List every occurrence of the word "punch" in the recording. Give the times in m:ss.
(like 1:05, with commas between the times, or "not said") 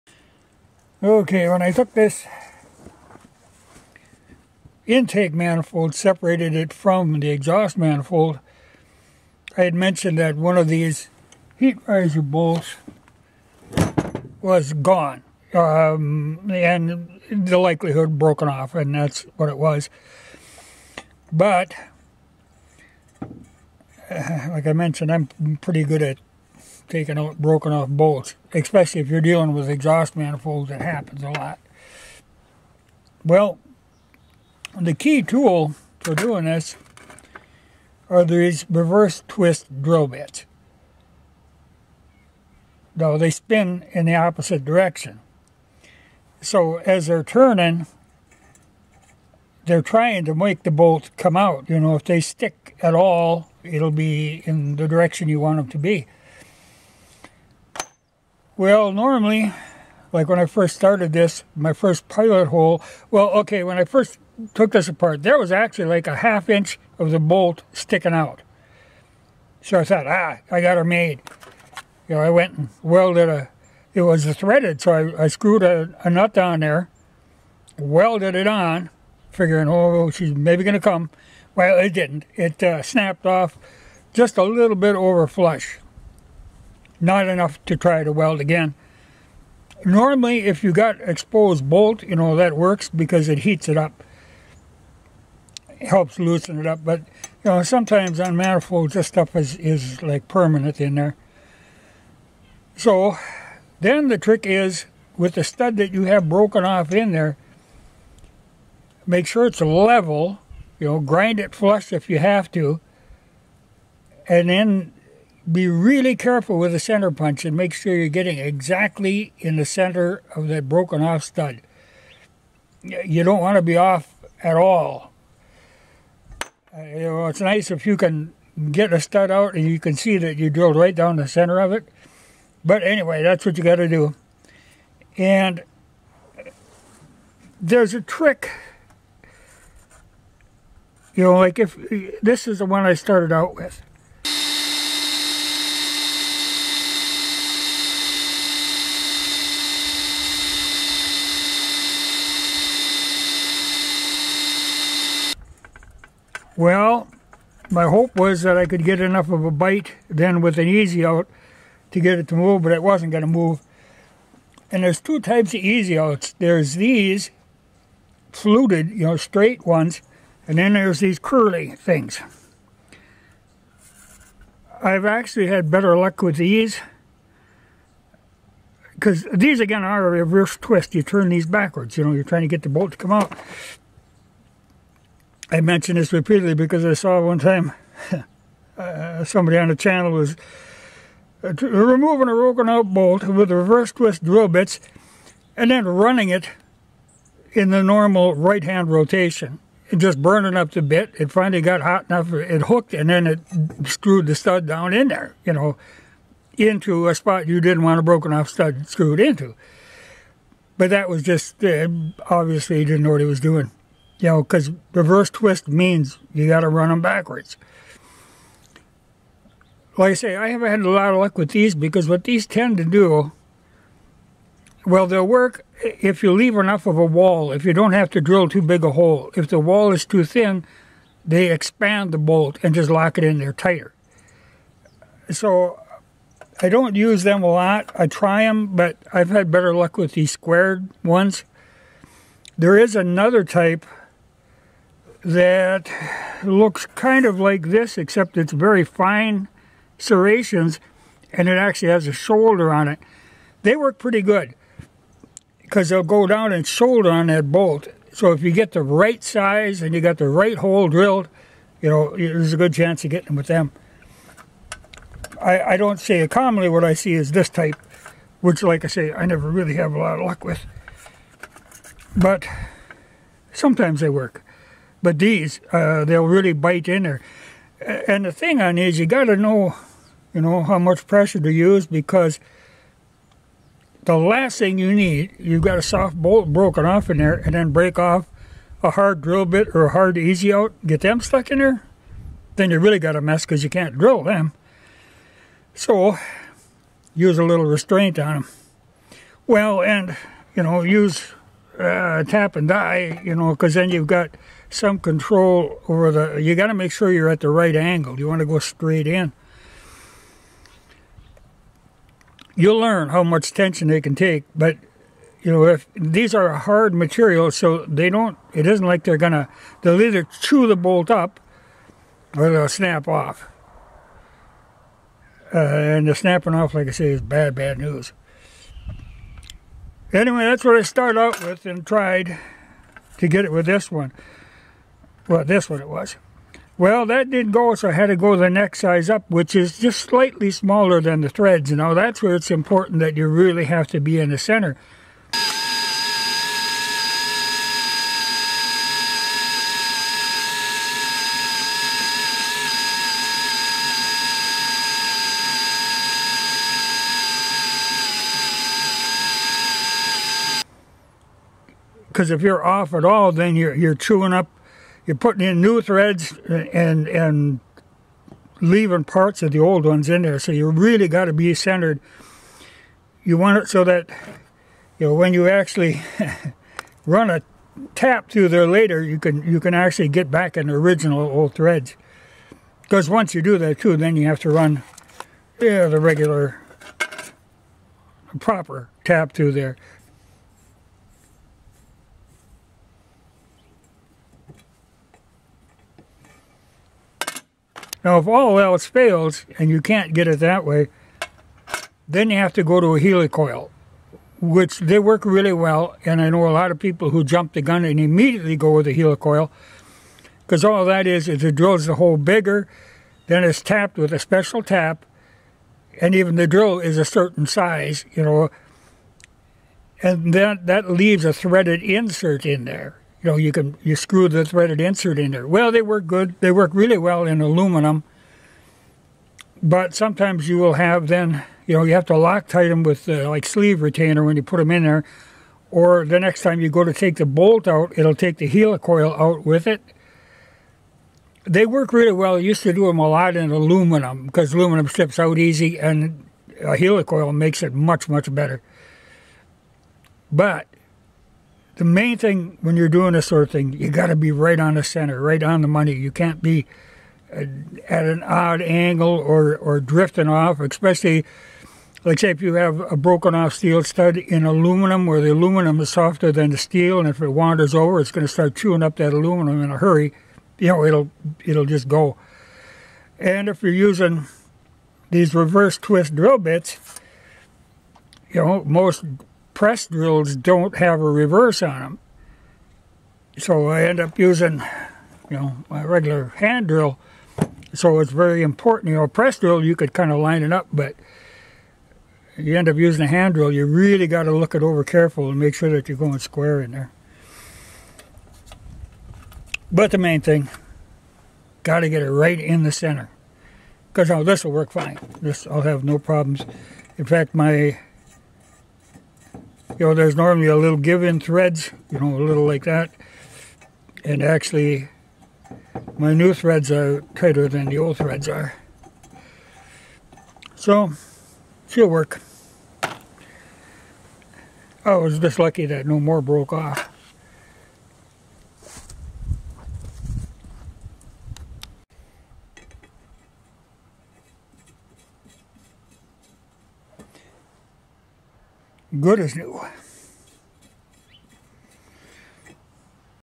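1:57.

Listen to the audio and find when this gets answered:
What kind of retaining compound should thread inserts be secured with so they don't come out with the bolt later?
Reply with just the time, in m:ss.
7:13.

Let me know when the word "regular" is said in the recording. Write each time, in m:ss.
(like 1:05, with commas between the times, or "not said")
6:25, 8:05.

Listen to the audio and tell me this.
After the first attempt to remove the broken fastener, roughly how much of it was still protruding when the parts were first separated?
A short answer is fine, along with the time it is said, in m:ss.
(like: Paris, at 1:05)
half inch, at 1:06.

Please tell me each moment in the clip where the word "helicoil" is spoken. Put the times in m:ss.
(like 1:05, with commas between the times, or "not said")
6:42, 6:48, 7:18, 7:26.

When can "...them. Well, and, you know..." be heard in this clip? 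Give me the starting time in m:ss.
4:58.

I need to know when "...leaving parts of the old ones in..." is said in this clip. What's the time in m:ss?
6:08.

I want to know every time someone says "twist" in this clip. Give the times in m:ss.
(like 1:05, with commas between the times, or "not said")
0:39, 3:00, 3:13, 3:35, 7:55.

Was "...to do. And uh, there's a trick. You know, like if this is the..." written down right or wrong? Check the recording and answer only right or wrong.
right.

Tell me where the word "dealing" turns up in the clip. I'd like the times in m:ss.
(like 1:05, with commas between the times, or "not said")
0:29.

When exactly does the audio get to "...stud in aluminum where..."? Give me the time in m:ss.
7:43.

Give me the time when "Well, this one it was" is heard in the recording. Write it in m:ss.
5:35.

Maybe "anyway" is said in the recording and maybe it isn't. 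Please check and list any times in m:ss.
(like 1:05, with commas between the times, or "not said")
2:12, 5:30.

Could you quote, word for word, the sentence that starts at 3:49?
If the wall is too thin, they expand the bolt and just lock it in there tighter.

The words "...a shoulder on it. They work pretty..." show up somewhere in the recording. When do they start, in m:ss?
4:12.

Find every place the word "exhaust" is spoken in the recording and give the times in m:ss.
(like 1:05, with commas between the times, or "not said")
0:07, 0:29.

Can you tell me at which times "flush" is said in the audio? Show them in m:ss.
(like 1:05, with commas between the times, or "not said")
1:25, 1:51.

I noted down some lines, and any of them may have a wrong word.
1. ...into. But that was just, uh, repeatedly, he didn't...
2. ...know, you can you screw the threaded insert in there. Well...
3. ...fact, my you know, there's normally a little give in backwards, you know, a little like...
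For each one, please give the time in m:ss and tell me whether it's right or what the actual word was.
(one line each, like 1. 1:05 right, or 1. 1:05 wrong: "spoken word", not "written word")
1. 3:29 wrong: "obviously", not "repeatedly"
2. 7:03 right
3. 8:27 wrong: "threads", not "backwards".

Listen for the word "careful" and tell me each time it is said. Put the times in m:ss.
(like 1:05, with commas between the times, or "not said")
1:56, 8:14.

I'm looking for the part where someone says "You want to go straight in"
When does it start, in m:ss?
5:08.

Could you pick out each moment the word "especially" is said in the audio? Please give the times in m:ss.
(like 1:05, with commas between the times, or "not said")
0:28, 7:40.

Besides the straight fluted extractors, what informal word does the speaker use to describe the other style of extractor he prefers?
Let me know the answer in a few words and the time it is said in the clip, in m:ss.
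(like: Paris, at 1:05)
curly things, at 2:51.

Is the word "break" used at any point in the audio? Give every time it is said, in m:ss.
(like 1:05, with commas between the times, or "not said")
4:47.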